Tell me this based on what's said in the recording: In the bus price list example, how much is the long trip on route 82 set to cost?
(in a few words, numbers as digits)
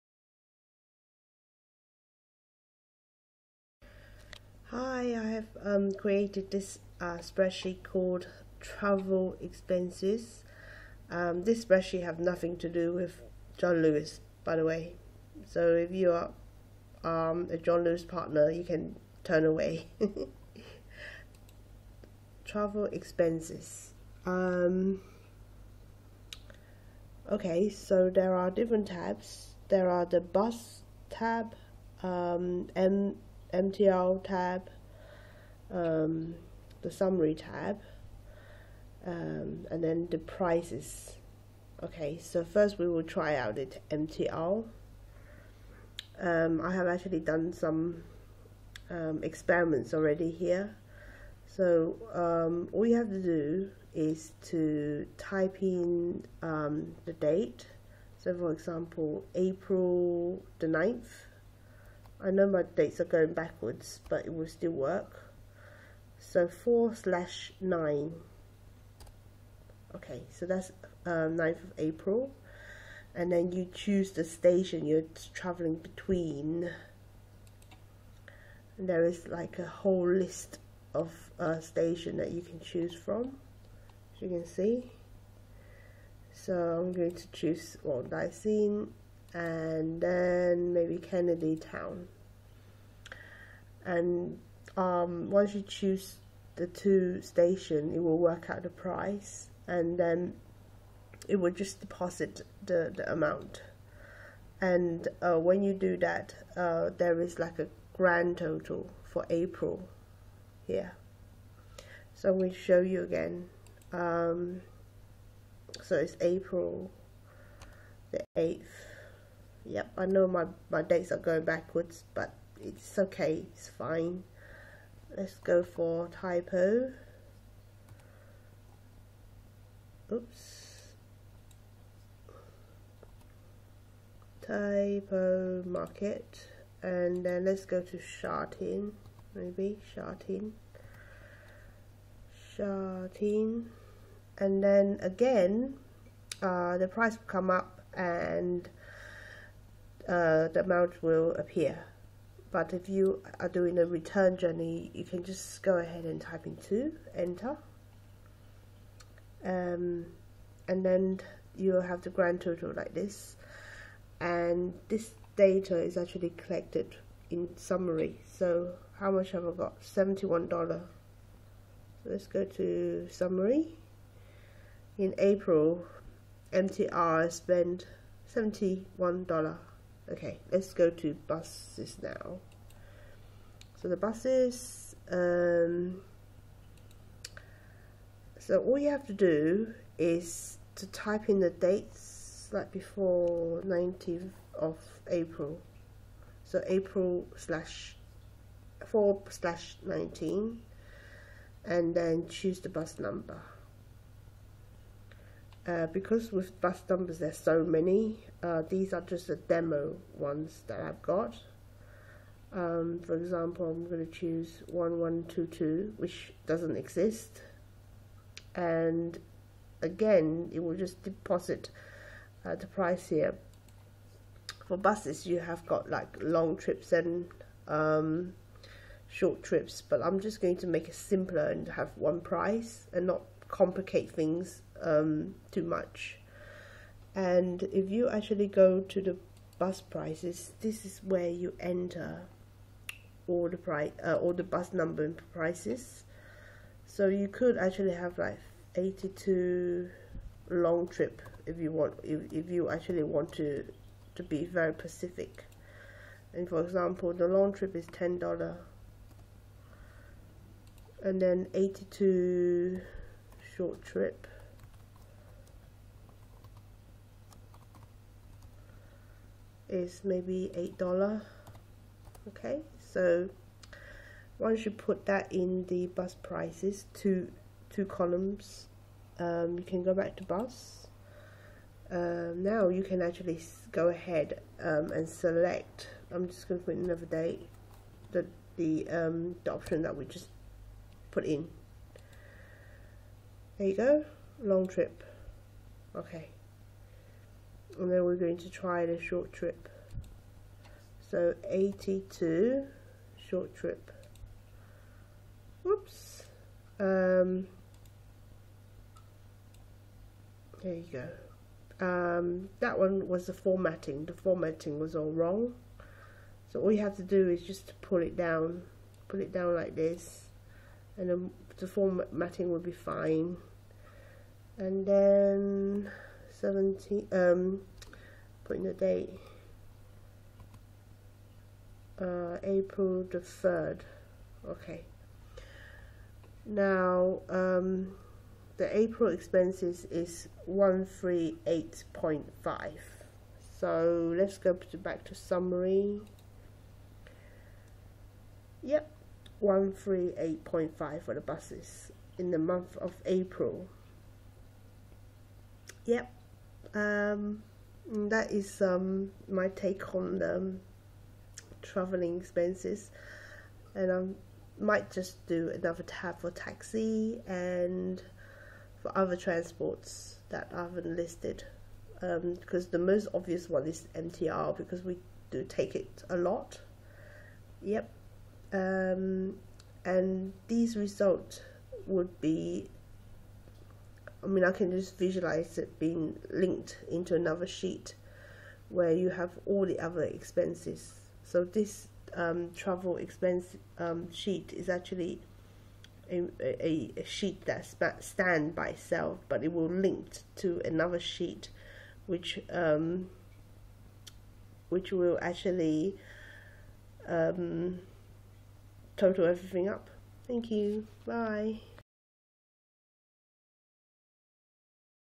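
$10.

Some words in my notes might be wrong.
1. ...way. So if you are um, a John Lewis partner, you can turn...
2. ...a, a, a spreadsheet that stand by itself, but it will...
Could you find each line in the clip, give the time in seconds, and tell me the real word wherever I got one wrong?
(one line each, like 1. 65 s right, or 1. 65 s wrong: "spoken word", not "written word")
1. 14 s right
2. 396 s wrong: "sheet", not "spreadsheet".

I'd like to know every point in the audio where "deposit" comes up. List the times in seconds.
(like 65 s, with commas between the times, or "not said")
101 s, 221 s.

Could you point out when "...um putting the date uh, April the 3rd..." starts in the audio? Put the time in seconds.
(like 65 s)
327 s.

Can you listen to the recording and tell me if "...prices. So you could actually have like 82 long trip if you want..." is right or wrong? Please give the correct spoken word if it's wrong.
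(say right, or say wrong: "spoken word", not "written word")
right.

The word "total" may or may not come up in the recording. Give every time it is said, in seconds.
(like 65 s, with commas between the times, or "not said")
108 s, 162 s, 408 s.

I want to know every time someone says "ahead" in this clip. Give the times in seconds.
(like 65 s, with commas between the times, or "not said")
155 s, 283 s.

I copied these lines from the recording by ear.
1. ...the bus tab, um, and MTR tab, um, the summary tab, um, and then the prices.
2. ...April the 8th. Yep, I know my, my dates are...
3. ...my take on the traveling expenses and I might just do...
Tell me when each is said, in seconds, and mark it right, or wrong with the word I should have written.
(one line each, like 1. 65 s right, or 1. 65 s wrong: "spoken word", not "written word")
1. 30 s right
2. 116 s right
3. 359 s right.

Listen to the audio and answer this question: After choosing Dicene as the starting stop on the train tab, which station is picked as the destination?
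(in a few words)
Kennedy Town.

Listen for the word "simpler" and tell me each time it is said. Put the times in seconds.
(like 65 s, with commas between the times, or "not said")
230 s.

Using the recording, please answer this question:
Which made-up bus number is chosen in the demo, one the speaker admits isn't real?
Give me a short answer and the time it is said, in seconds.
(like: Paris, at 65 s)
1122, at 214 s.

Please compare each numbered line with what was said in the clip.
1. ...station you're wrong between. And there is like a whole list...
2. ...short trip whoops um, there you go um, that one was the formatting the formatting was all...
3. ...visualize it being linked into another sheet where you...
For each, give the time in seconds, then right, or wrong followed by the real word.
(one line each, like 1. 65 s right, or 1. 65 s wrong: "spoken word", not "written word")
1. 74 s wrong: "traveling", not "wrong"
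2. 303 s right
3. 384 s right.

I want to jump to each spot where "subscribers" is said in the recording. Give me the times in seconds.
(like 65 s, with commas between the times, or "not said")
not said.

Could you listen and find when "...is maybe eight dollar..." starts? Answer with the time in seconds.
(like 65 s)
269 s.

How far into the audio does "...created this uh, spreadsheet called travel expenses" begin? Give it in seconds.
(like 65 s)
5 s.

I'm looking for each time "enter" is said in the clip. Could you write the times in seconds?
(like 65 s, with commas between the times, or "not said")
157 s, 241 s.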